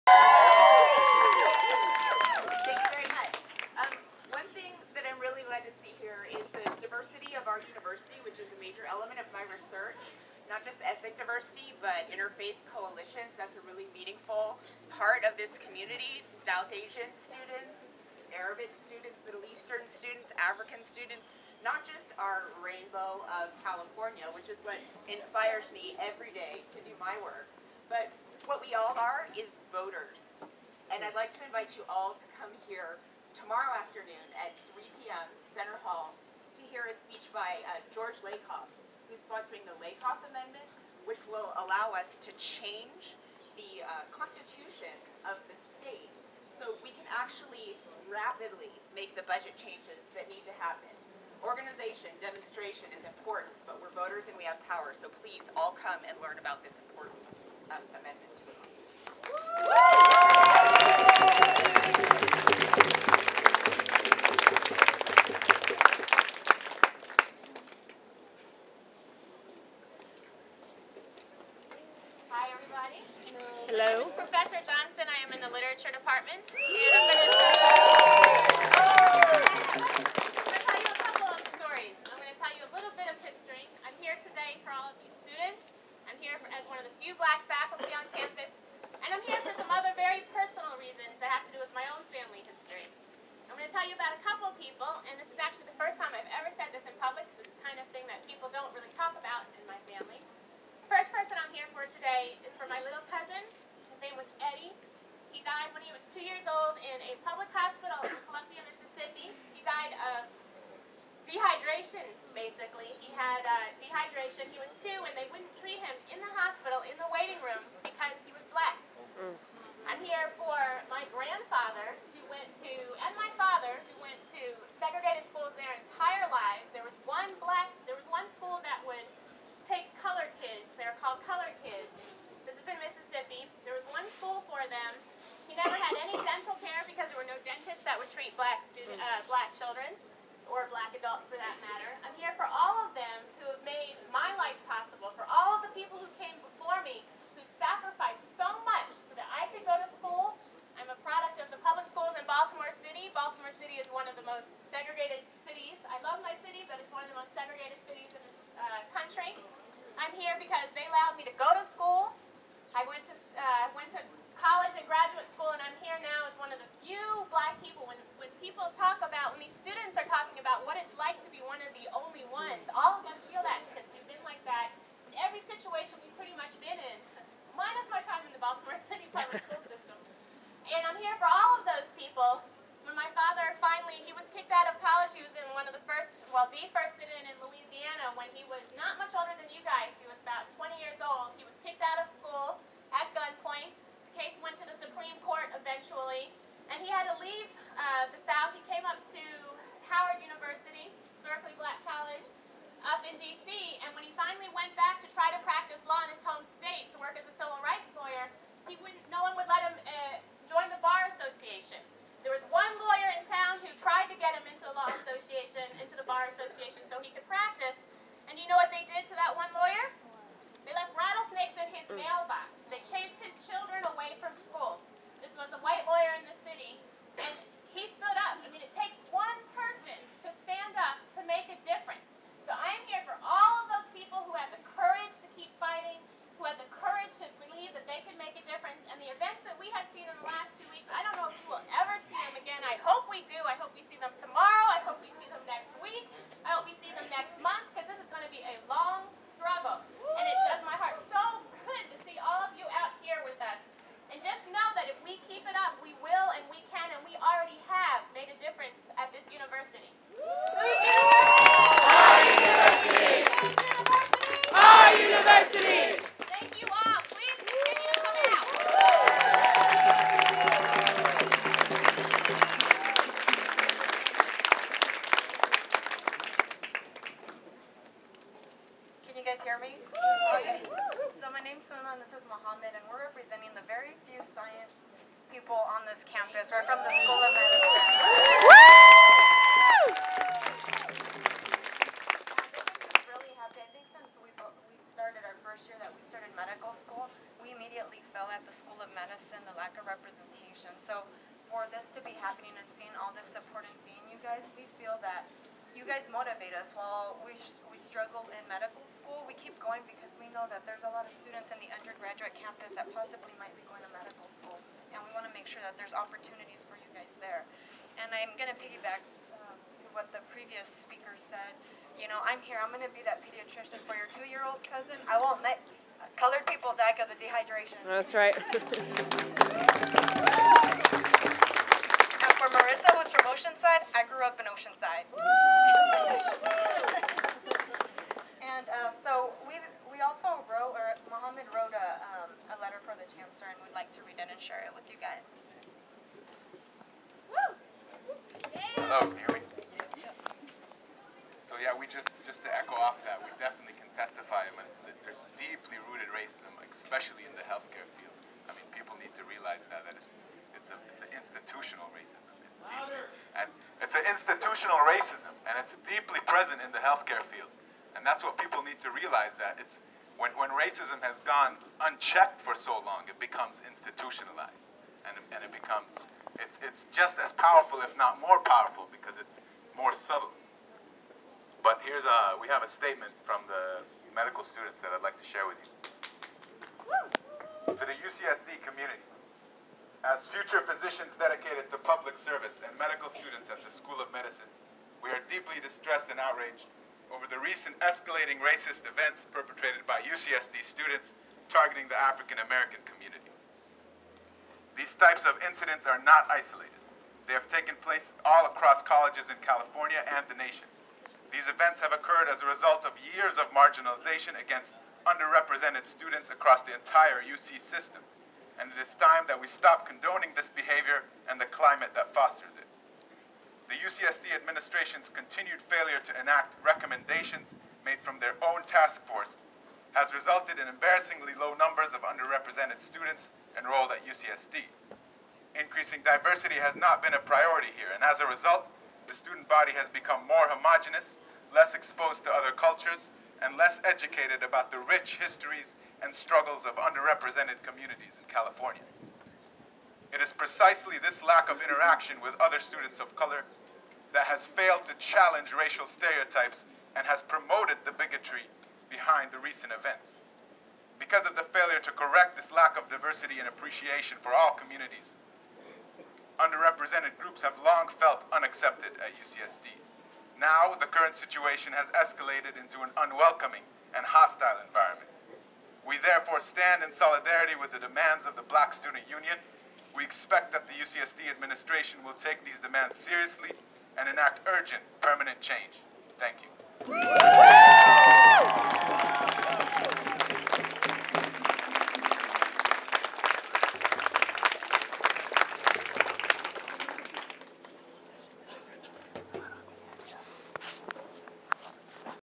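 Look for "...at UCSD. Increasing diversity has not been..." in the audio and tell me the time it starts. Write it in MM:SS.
07:13.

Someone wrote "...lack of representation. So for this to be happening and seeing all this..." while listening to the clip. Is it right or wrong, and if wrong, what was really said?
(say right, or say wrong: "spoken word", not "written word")
right.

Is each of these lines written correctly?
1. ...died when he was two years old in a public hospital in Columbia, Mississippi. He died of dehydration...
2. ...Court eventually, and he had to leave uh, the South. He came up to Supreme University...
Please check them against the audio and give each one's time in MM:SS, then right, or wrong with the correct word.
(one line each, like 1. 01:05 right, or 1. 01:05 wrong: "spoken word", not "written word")
1. 01:45 right
2. 03:15 wrong: "Howard", not "Supreme".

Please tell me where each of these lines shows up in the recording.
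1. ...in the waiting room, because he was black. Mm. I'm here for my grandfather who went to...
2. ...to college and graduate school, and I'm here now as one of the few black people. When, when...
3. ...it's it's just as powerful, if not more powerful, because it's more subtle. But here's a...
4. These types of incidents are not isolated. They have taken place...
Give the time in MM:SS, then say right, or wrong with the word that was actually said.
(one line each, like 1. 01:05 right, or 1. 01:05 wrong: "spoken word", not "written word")
1. 01:56 right
2. 02:43 right
3. 06:16 right
4. 06:44 right.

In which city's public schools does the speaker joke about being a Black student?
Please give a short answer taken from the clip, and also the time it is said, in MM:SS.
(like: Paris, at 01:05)
Baltimore, at 02:58.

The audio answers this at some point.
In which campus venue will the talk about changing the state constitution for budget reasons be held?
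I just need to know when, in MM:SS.
00:35.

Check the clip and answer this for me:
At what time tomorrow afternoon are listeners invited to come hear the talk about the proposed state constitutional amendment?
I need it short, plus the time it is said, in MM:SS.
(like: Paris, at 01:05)
3 p.m., at 00:34.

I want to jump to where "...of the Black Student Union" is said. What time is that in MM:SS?
07:58.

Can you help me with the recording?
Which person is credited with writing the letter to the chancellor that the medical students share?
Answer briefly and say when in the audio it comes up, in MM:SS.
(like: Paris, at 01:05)
Mohammed, at 05:41.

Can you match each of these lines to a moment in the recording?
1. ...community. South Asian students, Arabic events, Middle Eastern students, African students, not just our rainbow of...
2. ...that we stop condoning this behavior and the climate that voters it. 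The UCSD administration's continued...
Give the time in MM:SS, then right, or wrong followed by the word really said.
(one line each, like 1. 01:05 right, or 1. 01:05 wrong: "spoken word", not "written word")
1. 00:15 wrong: "students", not "events"
2. 06:59 wrong: "fosters", not "voters".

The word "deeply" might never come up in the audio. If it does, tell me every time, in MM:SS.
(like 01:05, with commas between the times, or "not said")
06:05, 06:35.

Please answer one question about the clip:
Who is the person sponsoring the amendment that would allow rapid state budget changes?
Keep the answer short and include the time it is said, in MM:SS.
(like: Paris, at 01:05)
George Lakoff, at 00:37.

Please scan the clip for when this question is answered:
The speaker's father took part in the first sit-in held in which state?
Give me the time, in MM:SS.
03:07.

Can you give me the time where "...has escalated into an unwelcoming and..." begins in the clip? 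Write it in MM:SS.
07:51.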